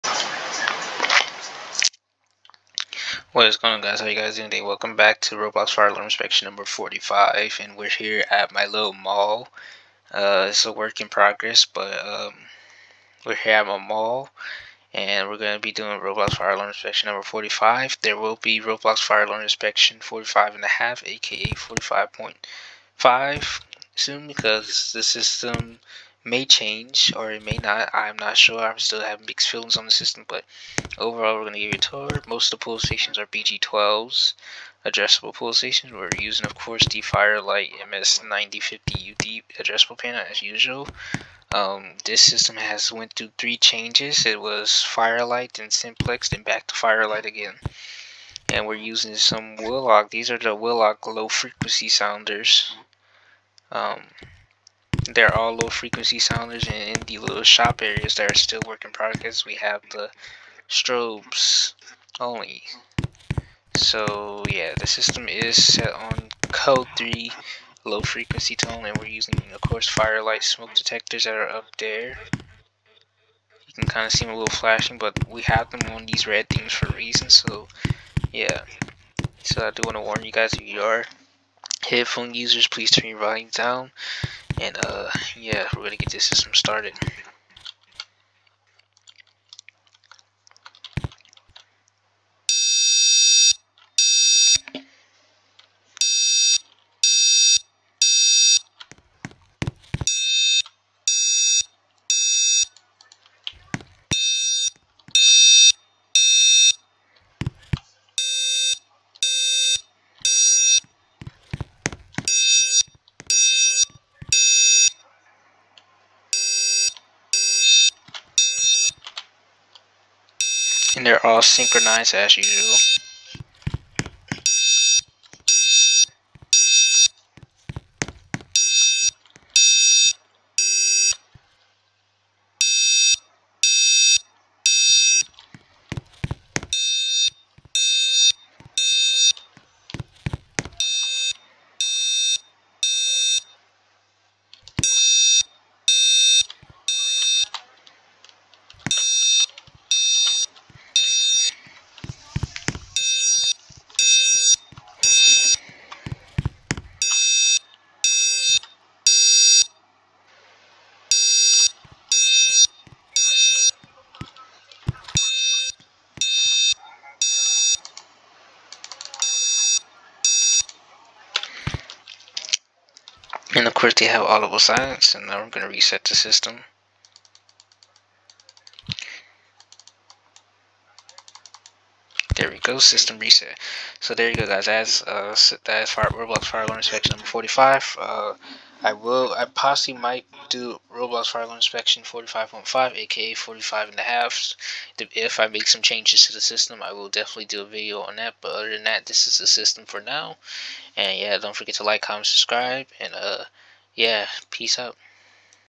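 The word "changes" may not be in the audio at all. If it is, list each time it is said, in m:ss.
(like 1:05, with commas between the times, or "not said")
0:26, 0:43, 3:15.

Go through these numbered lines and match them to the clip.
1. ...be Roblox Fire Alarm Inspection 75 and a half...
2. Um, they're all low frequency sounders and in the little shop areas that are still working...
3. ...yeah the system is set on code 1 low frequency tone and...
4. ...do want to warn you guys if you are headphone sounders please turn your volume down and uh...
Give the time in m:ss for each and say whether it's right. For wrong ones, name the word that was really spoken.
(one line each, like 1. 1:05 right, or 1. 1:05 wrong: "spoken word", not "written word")
1. 0:18 wrong: "45", not "75"
2. 0:53 right
3. 1:04 wrong: "3", not "1"
4. 1:19 wrong: "users", not "sounders".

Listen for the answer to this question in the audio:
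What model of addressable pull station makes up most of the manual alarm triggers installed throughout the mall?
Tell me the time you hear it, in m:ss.
0:33.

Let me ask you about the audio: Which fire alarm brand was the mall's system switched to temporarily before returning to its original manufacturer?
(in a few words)
Simplex.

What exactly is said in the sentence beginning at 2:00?
And they're all synchronized as usual.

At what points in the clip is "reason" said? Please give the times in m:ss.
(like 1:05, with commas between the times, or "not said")
1:16.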